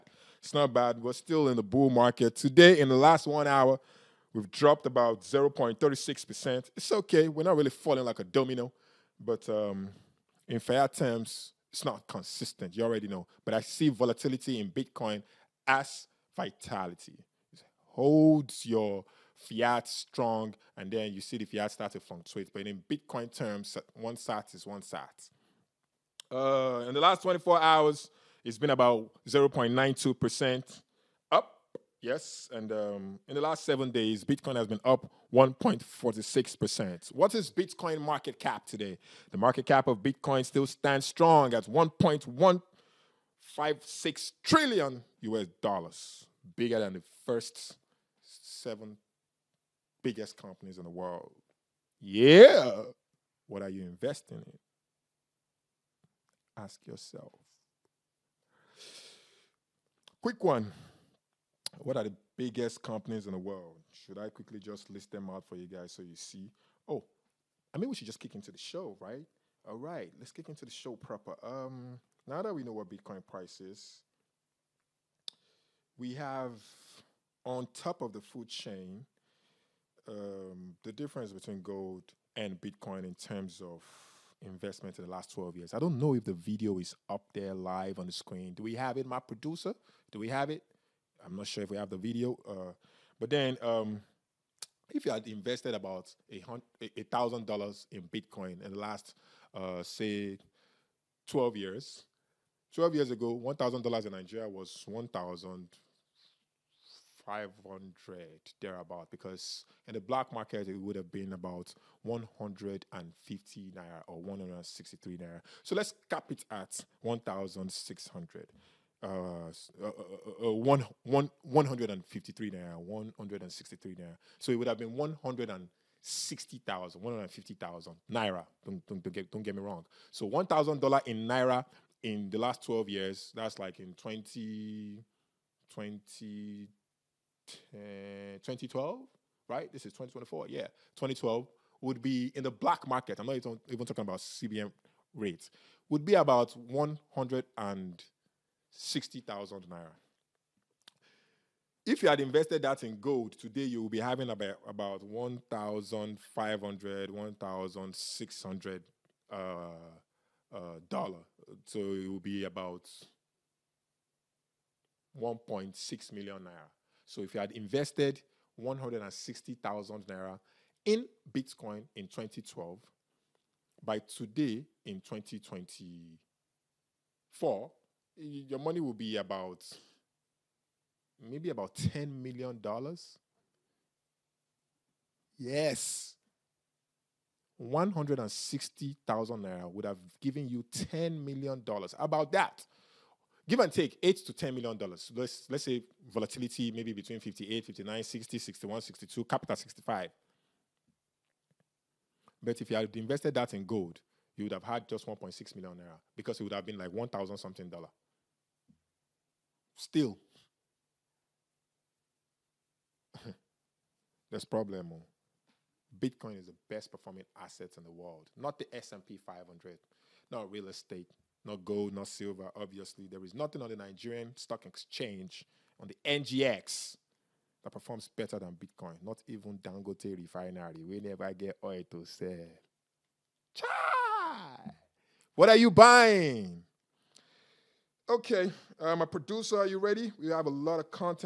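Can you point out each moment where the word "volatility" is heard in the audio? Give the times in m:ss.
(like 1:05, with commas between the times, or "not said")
0:13, 3:16.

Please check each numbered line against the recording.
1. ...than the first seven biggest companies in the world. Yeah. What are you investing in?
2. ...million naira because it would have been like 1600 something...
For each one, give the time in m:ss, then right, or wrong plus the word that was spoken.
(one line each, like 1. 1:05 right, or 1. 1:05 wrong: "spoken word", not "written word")
1. 0:46 right
2. 3:25 wrong: "1000", not "1600".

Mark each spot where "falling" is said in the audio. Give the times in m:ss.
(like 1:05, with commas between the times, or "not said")
0:07.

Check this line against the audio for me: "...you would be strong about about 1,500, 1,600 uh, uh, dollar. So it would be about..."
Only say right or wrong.
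wrong.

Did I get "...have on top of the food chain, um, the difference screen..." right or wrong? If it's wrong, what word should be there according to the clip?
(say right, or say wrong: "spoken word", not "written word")
wrong: "between", not "screen".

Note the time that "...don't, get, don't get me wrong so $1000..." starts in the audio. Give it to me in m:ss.
2:09.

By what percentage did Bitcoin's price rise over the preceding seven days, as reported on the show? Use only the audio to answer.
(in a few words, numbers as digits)
1.46%.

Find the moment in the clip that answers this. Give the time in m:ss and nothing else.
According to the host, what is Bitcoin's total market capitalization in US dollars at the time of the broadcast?
0:41.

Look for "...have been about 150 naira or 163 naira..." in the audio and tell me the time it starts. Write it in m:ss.
1:50.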